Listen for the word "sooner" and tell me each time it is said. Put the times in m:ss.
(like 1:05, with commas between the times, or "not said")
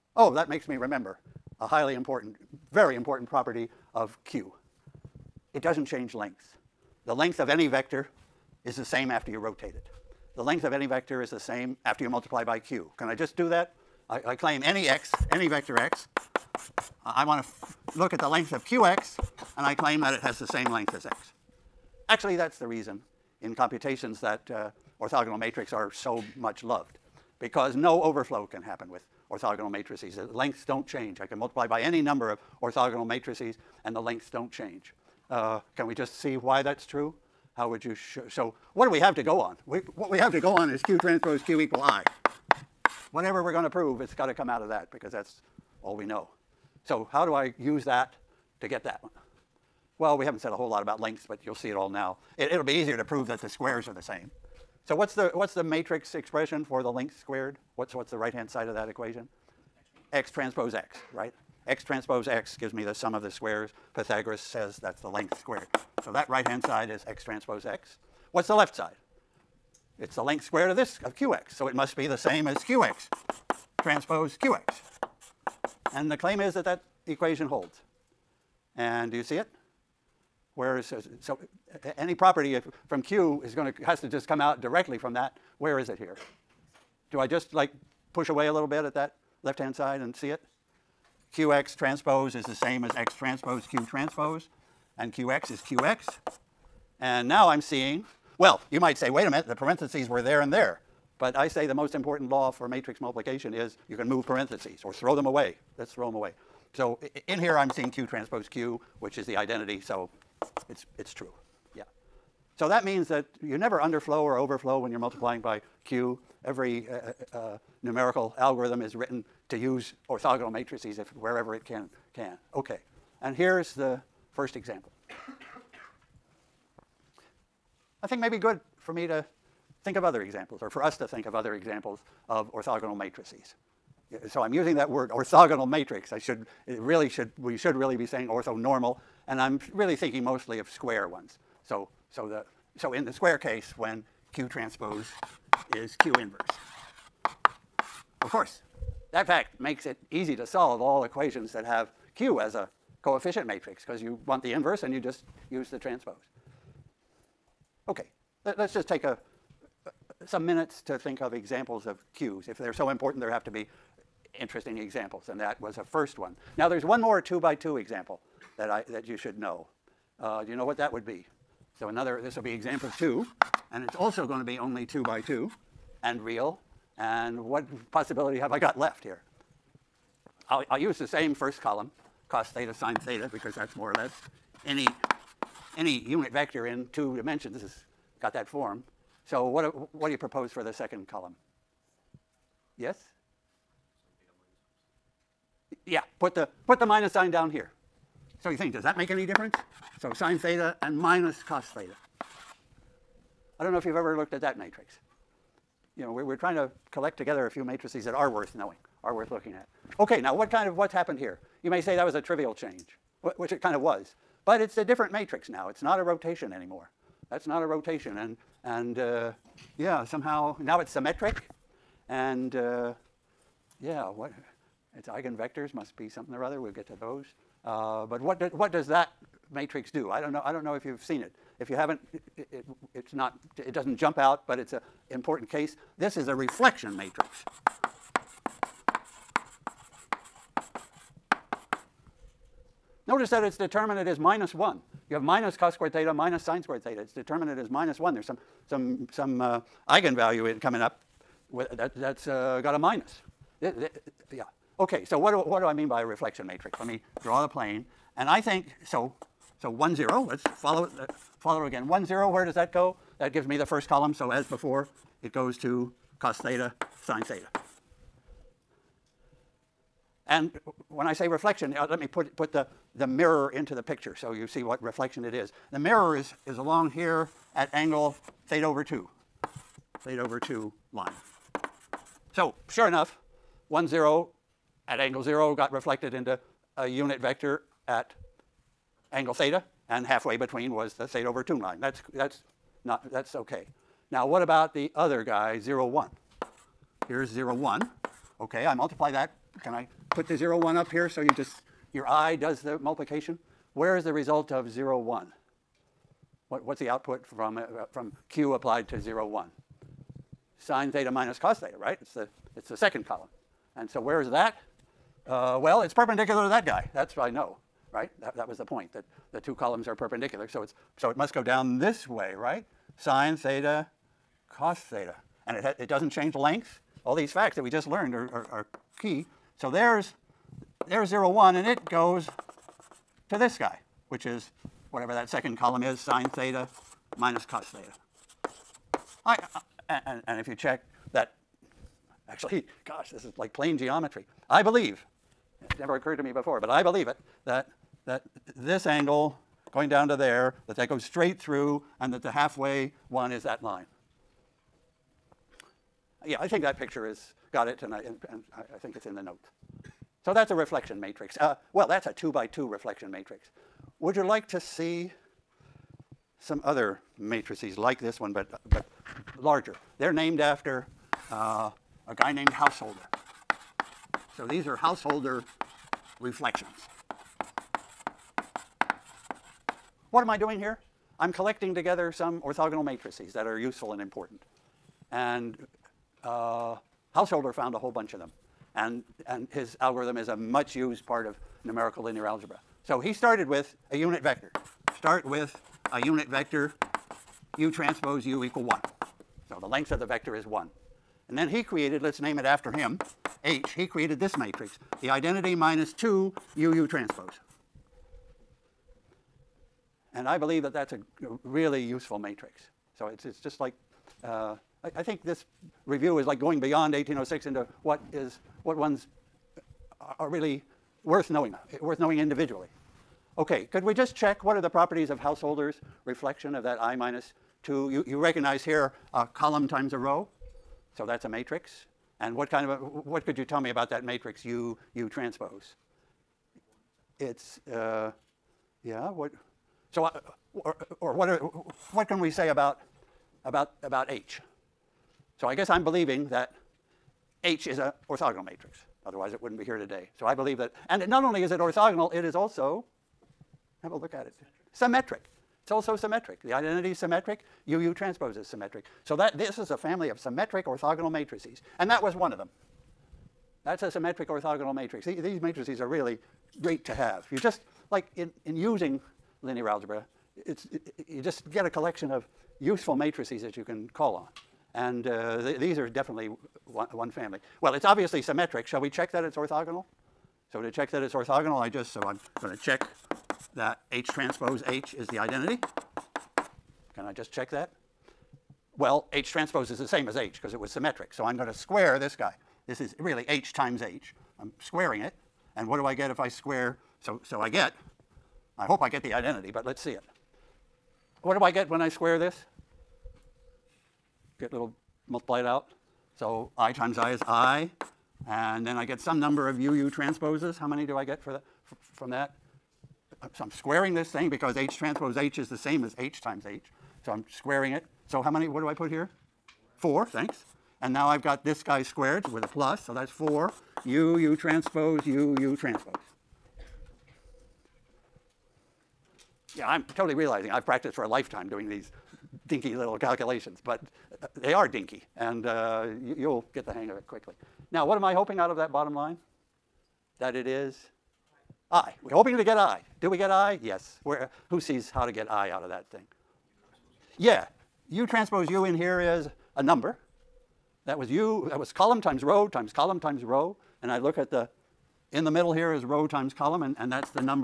not said.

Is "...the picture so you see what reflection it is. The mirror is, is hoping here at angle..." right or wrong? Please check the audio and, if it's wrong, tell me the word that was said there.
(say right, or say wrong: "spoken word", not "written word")
wrong: "along", not "hoping".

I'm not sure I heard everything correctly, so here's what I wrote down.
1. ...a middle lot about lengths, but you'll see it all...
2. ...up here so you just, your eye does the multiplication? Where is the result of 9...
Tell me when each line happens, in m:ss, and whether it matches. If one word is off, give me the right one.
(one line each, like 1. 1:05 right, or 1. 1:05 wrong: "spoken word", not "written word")
1. 0:50 wrong: "whole", not "middle"
2. 5:00 wrong: "0", not "9".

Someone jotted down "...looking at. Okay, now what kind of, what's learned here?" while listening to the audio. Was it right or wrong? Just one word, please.
wrong.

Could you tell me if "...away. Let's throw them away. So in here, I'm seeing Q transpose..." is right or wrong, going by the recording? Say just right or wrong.
right.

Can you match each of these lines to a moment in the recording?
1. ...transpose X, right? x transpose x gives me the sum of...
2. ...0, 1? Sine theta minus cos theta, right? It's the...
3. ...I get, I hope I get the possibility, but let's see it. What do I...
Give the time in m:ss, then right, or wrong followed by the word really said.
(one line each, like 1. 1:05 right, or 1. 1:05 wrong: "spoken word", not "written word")
1. 1:00 right
2. 5:08 right
3. 8:17 wrong: "identity", not "possibility".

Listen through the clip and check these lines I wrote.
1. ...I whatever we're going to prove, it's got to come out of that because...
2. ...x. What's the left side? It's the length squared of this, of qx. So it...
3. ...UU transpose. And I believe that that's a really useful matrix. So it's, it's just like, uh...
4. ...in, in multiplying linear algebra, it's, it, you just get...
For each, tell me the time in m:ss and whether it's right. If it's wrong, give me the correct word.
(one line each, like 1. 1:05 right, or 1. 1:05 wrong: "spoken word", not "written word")
1. 0:41 right
2. 1:07 right
3. 6:46 right
4. 7:48 wrong: "using", not "multiplying".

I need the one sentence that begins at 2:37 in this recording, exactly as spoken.
Okay, let's just take a some minutes to think of examples of cues.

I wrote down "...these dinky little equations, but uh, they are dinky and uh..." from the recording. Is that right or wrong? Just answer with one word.
wrong.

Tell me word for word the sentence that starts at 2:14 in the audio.
So I'm using that word orthogonal matrix.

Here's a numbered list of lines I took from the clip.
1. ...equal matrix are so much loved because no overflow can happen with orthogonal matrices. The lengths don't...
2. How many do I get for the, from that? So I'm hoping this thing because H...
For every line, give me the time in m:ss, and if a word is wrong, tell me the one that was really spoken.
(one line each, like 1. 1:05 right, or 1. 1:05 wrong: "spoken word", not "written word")
1. 0:24 wrong: "orthogonal", not "equal"
2. 8:30 wrong: "squaring", not "hoping".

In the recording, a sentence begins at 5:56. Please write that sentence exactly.
Yeah, I think that picture has got it, and I, and, and I, I, think it's in the note.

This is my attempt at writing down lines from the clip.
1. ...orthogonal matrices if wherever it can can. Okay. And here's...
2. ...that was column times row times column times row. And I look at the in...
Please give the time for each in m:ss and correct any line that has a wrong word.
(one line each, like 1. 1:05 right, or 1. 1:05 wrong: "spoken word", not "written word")
1. 2:00 right
2. 9:11 right.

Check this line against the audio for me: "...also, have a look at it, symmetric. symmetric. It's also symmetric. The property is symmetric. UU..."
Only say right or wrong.
wrong.